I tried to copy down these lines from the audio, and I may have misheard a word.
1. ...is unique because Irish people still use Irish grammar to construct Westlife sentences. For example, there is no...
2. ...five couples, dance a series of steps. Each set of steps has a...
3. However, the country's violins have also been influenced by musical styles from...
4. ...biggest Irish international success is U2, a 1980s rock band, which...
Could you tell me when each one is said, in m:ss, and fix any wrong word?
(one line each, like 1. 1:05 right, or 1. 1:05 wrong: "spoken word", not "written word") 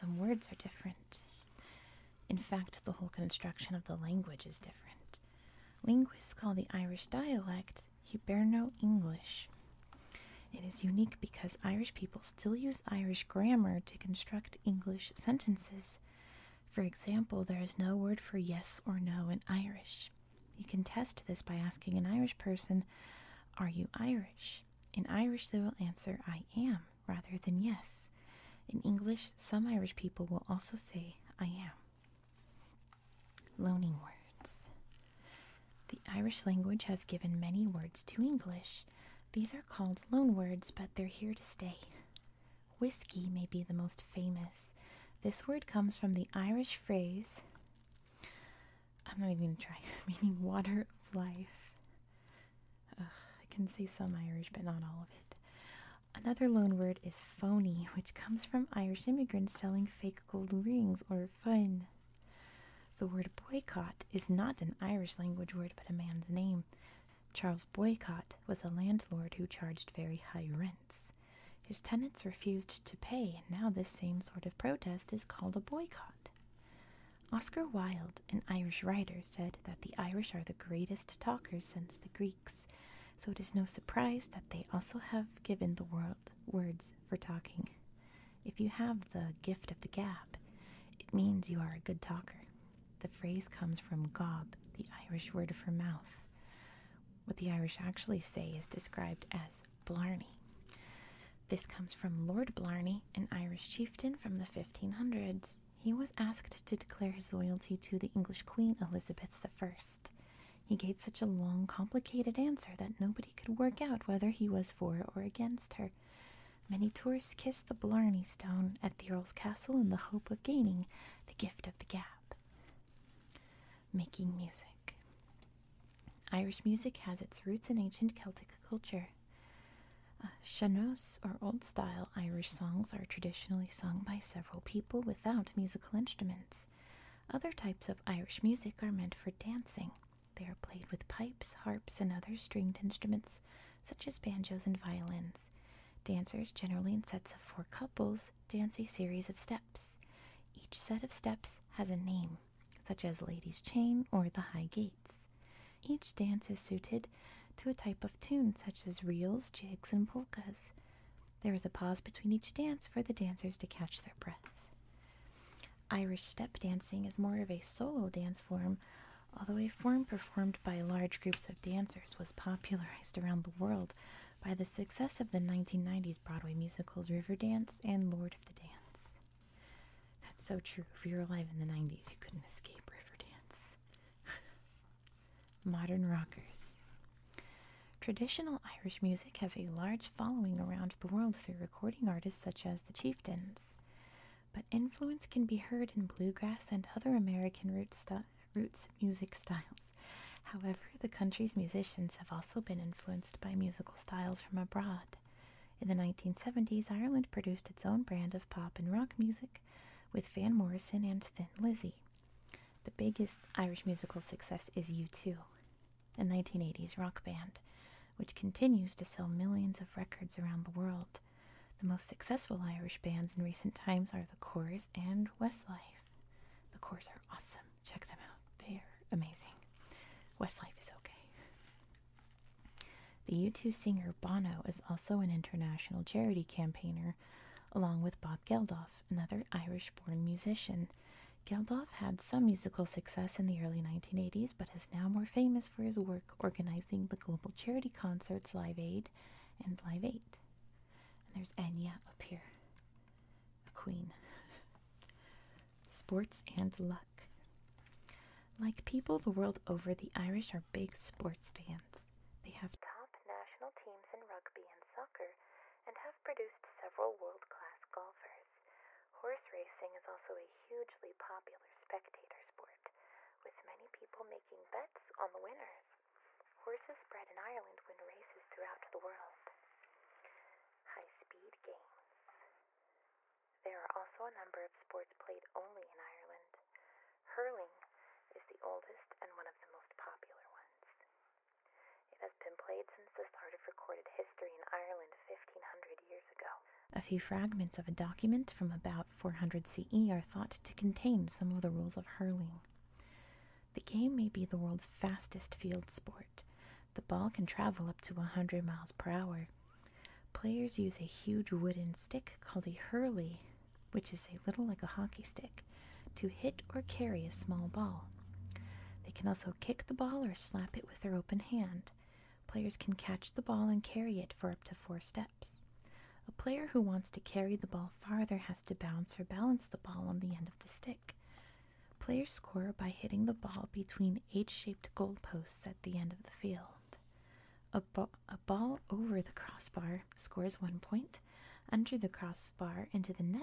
1. 0:10 wrong: "English", not "Westlife"
2. 2:27 wrong: "four", not "five"
3. 3:20 wrong: "musicians", not "violins"
4. 3:32 wrong: "musical", not "international".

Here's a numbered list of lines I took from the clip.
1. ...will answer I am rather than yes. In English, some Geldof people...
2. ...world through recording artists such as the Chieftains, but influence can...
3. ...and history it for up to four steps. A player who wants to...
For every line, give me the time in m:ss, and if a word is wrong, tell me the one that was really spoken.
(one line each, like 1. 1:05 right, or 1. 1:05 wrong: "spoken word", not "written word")
1. 0:25 wrong: "Irish", not "Geldof"
2. 3:11 right
3. 5:23 wrong: "carry", not "history".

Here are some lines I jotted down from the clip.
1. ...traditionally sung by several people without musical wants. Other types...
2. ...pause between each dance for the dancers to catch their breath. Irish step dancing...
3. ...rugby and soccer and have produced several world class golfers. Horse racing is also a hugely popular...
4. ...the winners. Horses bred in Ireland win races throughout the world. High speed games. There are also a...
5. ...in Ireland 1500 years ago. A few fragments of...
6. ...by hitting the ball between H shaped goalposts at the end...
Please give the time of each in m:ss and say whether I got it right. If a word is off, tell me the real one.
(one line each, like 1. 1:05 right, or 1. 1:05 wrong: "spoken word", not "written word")
1. 2:13 wrong: "instruments", not "wants"
2. 2:41 right
3. 4:24 right
4. 4:35 right
5. 4:54 right
6. 5:32 right.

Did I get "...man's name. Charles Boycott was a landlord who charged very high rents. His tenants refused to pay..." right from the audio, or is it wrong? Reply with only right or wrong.
right.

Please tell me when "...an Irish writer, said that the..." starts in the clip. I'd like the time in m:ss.
1:18.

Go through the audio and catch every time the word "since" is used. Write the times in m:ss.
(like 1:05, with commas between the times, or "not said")
1:21, 4:52.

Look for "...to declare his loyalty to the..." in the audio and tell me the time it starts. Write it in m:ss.
1:46.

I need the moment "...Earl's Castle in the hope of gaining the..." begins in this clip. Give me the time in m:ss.
1:59.